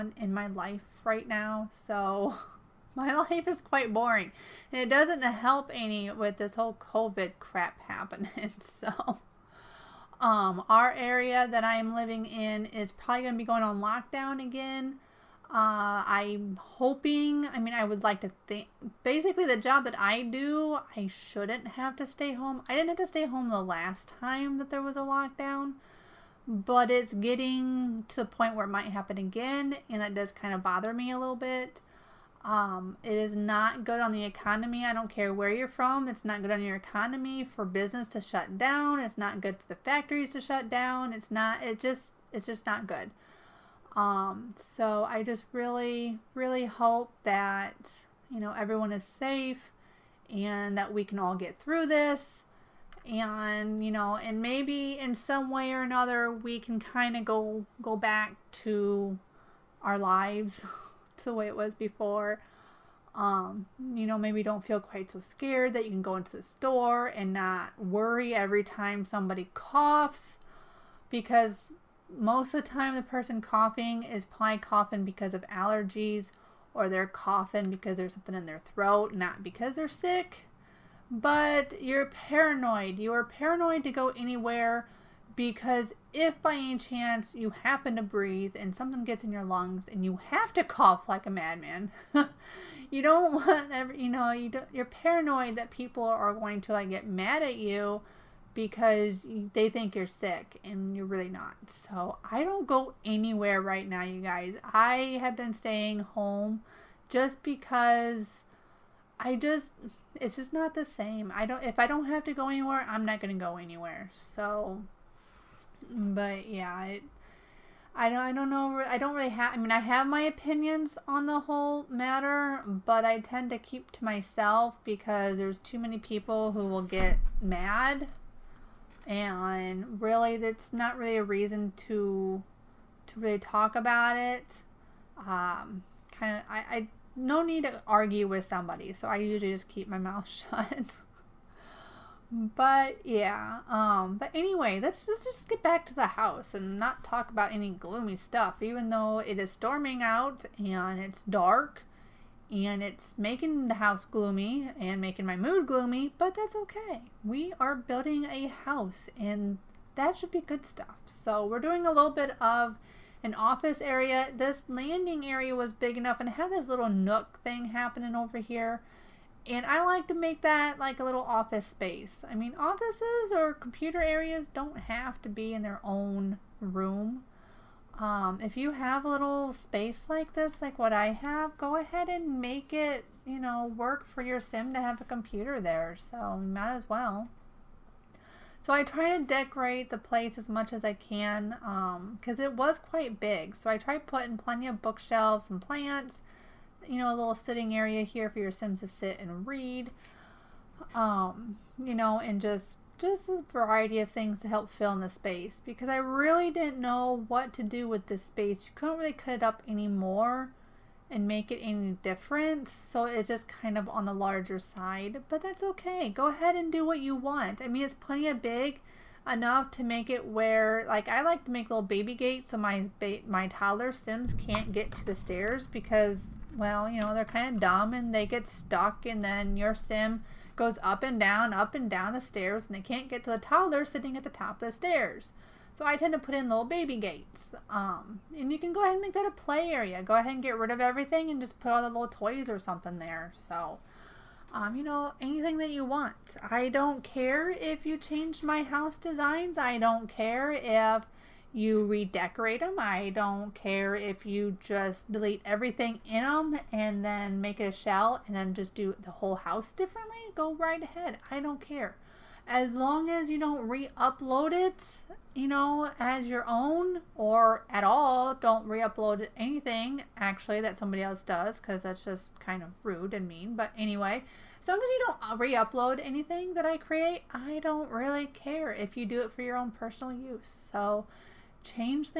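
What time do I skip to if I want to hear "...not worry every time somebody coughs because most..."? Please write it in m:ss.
1:07.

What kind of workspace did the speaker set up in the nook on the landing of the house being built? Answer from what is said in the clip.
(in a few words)
office space.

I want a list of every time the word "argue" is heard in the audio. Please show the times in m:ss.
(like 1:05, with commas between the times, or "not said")
2:17.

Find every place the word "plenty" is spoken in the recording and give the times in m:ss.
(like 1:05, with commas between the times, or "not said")
3:14, 3:37.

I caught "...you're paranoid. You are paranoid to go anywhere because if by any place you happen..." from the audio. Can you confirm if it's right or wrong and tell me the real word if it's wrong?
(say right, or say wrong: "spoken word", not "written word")
wrong: "chance", not "place".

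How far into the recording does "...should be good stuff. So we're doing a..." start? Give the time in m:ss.
2:40.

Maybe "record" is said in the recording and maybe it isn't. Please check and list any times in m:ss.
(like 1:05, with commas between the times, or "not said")
not said.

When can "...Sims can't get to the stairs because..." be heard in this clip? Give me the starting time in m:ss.
3:43.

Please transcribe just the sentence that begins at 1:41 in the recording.
So I don't go anywhere right now, you guys.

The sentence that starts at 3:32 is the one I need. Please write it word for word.
So it's just kind of on the larger side, but that's okay.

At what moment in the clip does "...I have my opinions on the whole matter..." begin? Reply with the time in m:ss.
1:59.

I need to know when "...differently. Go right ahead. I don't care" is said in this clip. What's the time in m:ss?
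4:19.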